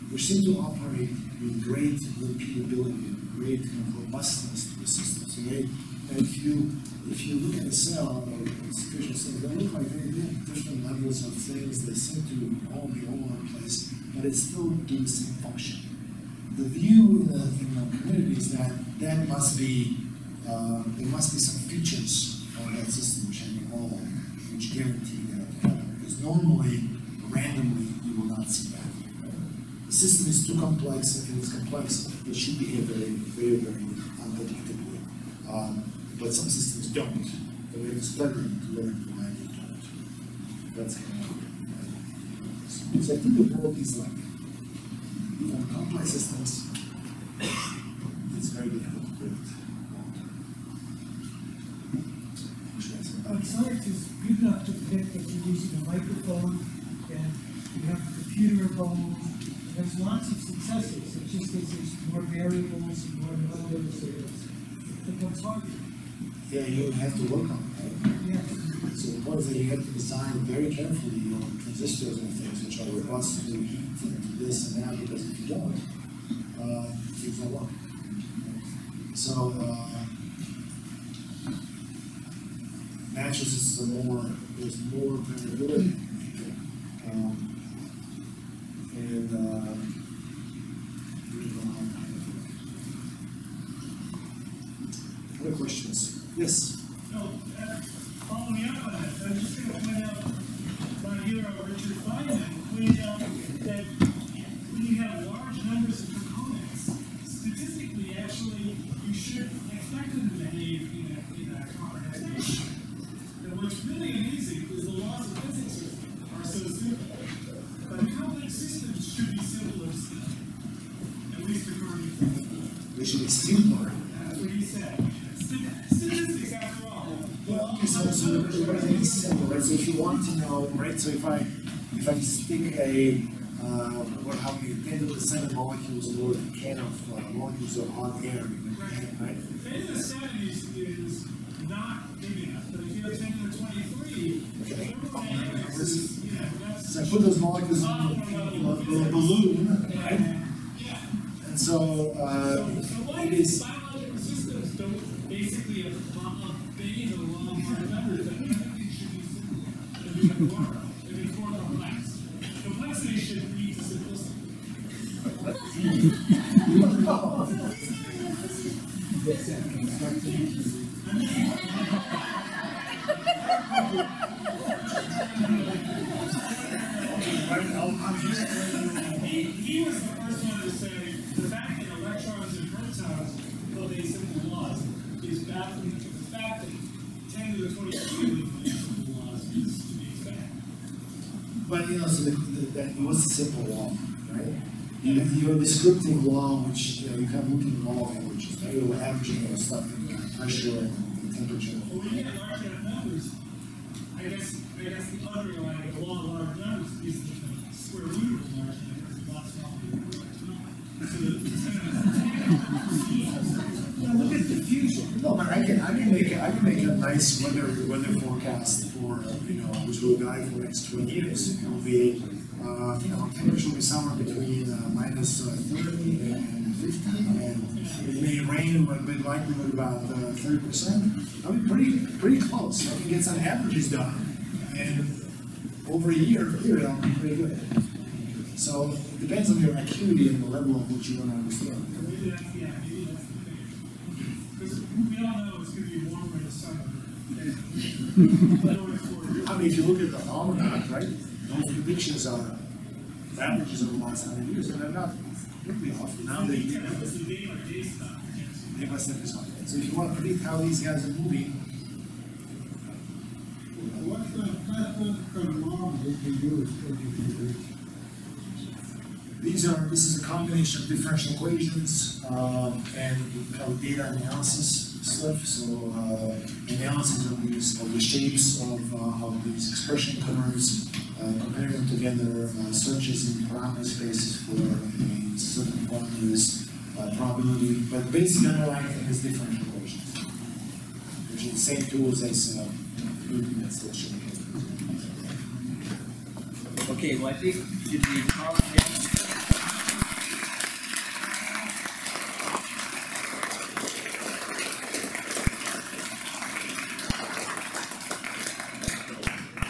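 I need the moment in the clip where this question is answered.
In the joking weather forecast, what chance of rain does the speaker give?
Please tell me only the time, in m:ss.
3:50.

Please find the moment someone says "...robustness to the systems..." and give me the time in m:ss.
0:04.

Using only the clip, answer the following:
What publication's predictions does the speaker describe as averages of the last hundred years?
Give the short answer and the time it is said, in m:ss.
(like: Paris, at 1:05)
The almanac, at 4:10.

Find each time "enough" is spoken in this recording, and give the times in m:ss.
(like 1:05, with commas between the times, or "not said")
0:54, 2:22, 3:22.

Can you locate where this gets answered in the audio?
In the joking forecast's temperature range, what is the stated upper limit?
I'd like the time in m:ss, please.
3:46.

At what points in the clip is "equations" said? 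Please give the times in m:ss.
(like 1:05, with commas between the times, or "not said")
4:31, 4:49.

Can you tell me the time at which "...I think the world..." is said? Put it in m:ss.
0:43.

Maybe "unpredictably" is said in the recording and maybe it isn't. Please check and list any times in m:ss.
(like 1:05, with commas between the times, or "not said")
0:34.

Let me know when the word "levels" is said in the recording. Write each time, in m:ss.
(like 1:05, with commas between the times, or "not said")
0:10, 4:00.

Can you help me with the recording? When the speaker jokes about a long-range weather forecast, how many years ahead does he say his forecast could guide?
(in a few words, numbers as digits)
20.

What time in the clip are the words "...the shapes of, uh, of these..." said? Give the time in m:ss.
4:37.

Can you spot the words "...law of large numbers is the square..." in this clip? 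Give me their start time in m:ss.
3:25.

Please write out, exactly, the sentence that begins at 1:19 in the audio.
So uh, natural systems are more, there's more variability.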